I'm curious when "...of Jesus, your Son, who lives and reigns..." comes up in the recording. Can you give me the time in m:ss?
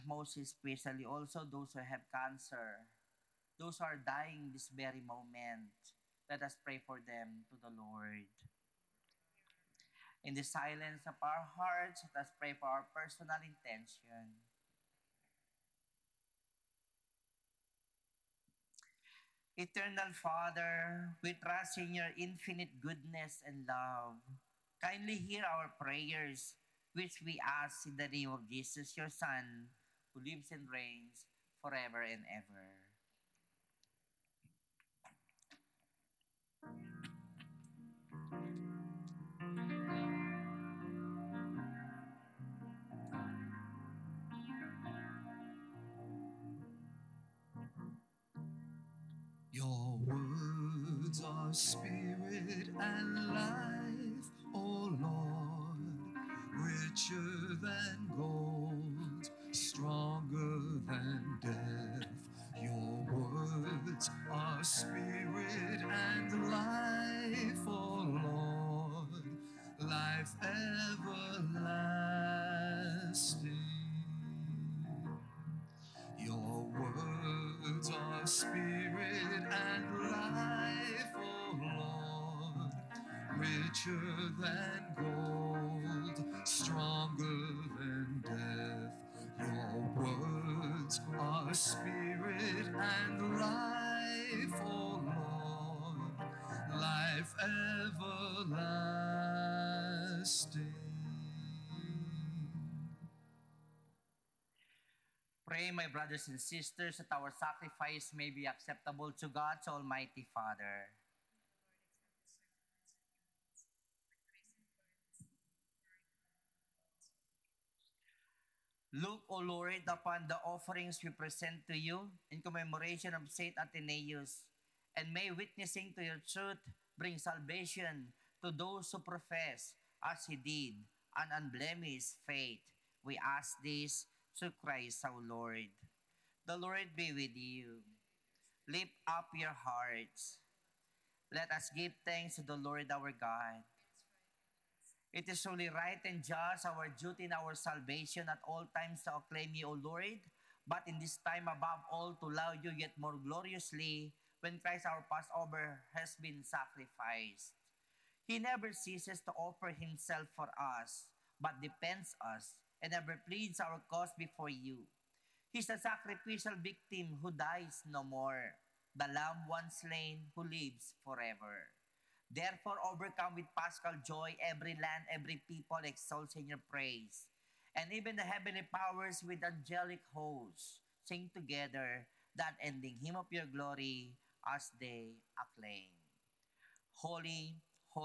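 0:28.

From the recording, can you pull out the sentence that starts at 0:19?
Eternal Father, we trust in your infinite goodness and love.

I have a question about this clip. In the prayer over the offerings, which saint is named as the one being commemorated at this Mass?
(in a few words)
St. Athanasius.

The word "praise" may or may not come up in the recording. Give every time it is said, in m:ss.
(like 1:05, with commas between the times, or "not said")
2:56.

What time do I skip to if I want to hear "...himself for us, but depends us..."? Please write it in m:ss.
2:39.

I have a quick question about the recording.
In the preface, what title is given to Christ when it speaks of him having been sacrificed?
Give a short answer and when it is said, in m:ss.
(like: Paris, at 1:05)
our Passover, at 2:34.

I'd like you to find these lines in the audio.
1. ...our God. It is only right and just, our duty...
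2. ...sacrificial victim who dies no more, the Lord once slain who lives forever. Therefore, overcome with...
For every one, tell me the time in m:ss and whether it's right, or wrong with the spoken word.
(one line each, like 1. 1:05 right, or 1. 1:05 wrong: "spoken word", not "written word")
1. 2:22 right
2. 2:45 wrong: "Lamb", not "Lord".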